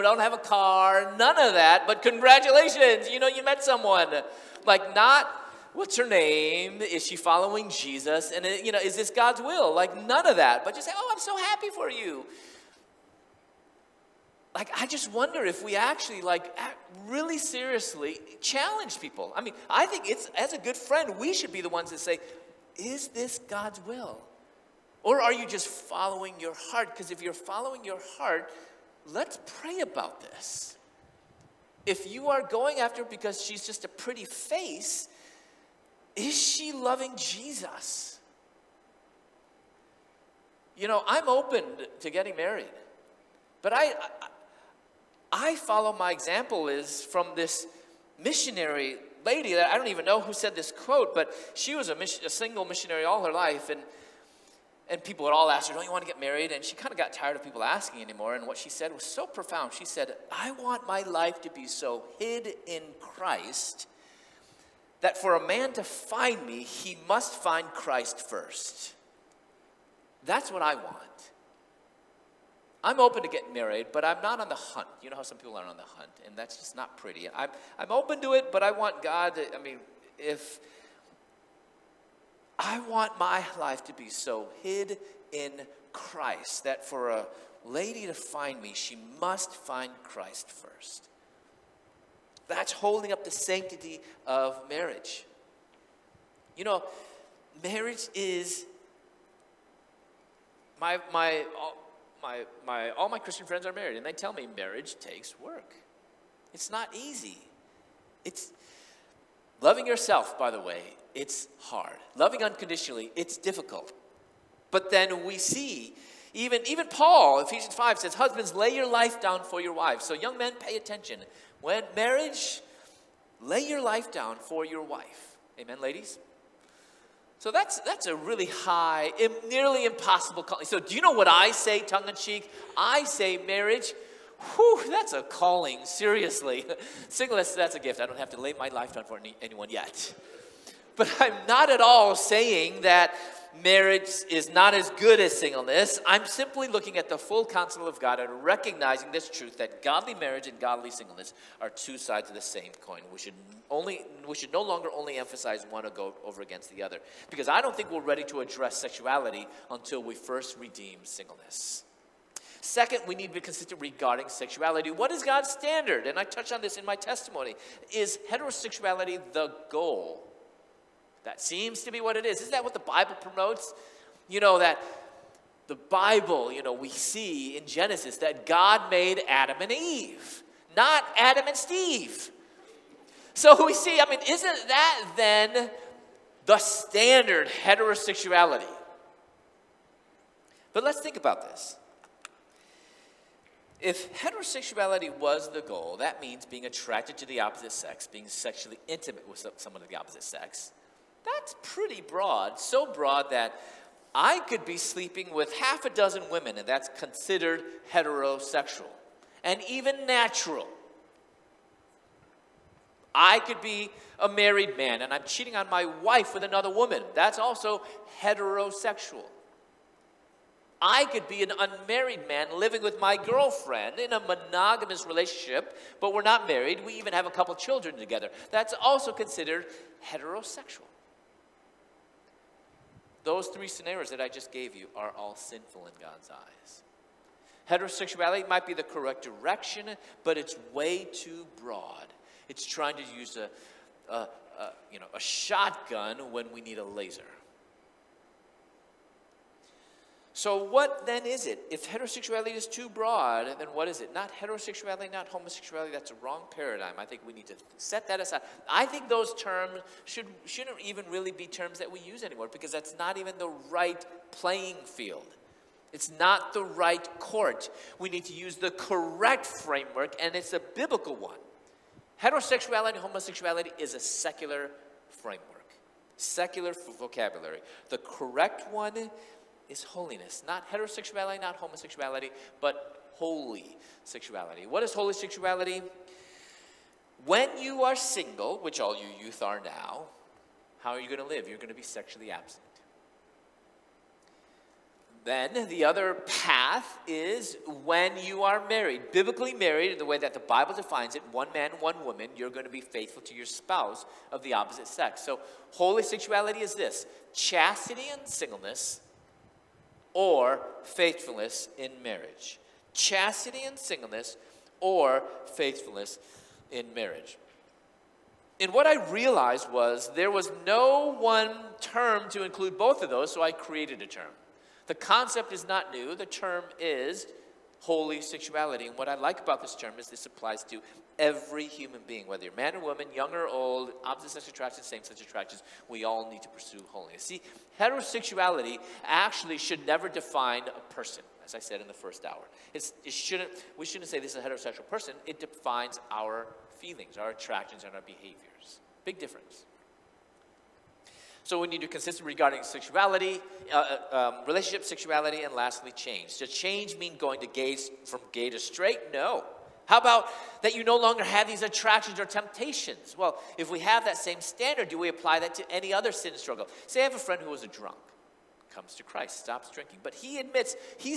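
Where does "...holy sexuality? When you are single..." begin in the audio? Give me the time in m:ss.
4:44.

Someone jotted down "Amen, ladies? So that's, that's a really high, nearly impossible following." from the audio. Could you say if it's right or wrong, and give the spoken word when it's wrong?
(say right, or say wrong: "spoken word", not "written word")
wrong: "calling", not "following".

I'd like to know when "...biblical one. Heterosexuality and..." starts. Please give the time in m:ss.
4:30.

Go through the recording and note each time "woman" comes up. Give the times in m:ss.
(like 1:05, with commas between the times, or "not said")
3:36, 5:02, 5:32.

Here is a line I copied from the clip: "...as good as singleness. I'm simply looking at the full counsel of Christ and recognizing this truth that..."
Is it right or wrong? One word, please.
wrong.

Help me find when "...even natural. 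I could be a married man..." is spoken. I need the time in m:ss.
3:29.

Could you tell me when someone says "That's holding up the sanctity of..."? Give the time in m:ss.
1:32.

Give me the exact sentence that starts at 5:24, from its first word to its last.
The concept is not new, the term is holy sexuality.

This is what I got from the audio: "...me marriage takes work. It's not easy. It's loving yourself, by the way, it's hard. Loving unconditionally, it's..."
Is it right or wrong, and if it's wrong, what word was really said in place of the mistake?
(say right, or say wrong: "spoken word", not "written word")
right.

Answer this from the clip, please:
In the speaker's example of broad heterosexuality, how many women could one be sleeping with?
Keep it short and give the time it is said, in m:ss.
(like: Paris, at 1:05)
half a dozen, at 3:25.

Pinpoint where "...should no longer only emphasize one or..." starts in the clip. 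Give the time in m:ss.
2:34.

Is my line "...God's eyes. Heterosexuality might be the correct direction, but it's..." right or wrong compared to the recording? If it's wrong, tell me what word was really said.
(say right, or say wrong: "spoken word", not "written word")
right.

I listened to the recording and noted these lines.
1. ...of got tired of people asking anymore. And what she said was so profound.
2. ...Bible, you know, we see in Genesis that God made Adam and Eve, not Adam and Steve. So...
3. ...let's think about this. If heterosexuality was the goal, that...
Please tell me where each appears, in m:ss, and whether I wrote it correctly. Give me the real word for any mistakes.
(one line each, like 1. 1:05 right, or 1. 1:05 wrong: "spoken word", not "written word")
1. 0:56 right
2. 2:55 right
3. 3:10 right.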